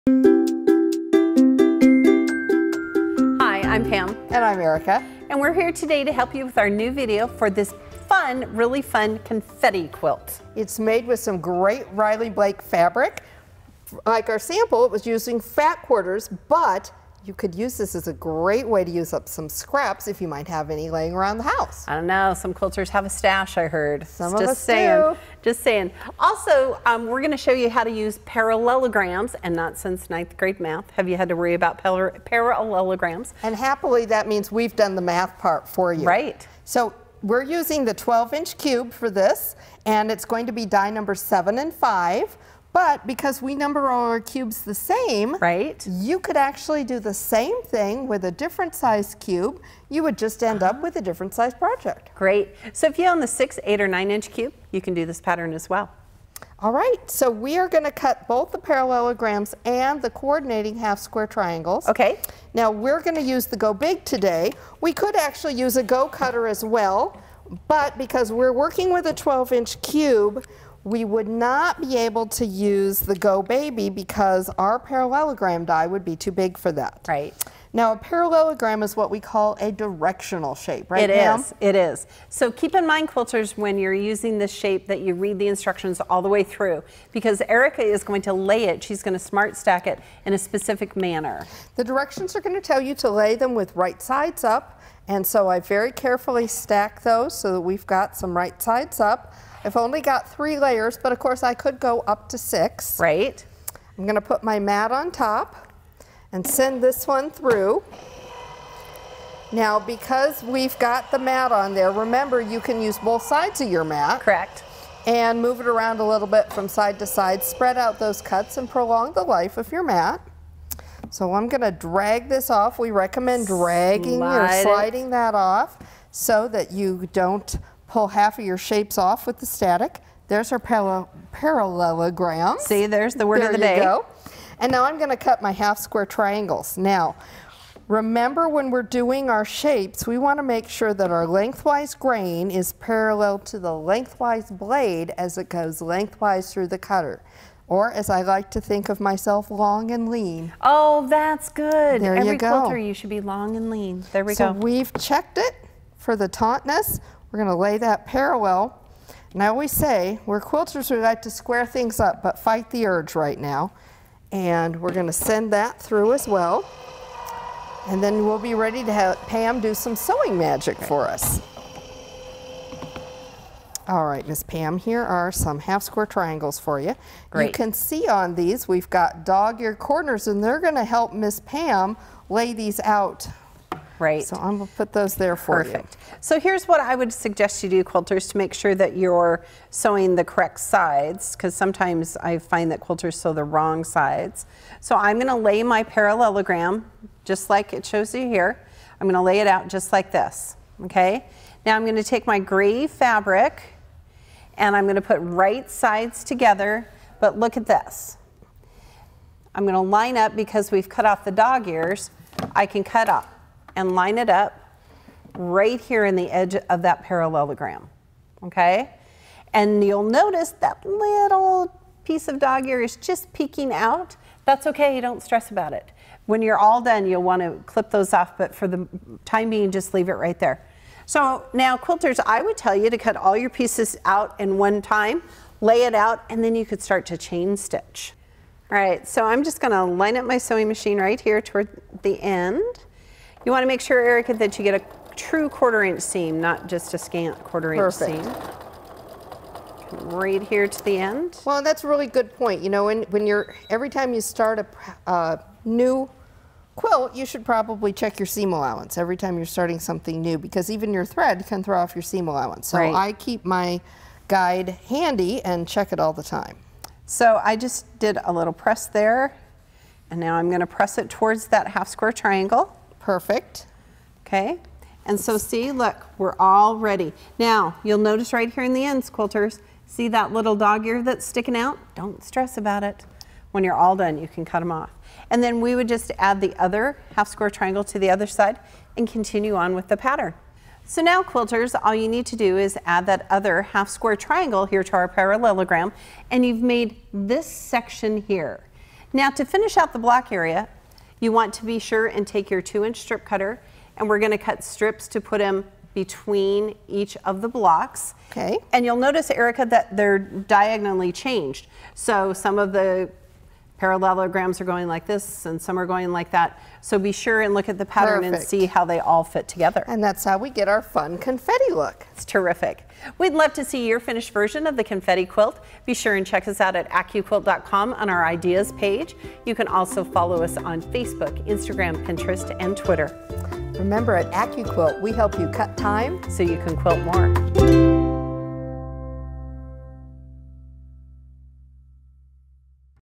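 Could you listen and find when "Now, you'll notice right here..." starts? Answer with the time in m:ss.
4:37.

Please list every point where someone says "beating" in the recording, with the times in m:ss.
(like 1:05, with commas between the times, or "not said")
not said.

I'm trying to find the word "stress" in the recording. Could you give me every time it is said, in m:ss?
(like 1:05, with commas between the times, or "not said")
3:45, 4:42.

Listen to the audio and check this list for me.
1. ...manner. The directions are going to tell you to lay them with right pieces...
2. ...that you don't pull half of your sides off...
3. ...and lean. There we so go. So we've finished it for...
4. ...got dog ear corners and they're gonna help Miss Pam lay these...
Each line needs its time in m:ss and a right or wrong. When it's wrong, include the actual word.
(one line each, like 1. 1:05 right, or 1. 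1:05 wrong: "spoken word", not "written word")
1. 1:30 wrong: "sides", not "pieces"
2. 2:06 wrong: "shapes", not "sides"
3. 2:33 wrong: "checked", not "finished"
4. 2:58 right.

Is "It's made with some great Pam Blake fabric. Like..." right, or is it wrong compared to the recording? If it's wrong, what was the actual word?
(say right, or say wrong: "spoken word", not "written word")
wrong: "Riley", not "Pam".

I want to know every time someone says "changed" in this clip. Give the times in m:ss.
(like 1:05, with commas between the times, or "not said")
5:11.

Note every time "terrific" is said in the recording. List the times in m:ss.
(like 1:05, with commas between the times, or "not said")
5:22.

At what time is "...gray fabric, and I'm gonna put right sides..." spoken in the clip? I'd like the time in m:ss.
3:22.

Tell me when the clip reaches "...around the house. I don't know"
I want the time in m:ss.
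0:21.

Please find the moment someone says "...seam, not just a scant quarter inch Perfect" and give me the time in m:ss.
4:06.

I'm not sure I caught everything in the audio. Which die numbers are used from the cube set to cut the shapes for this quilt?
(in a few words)
7 and 5.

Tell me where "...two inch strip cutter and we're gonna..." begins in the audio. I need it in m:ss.
5:02.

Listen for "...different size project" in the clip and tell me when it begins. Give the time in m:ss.
0:51.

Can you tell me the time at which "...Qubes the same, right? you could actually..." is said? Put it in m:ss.
0:44.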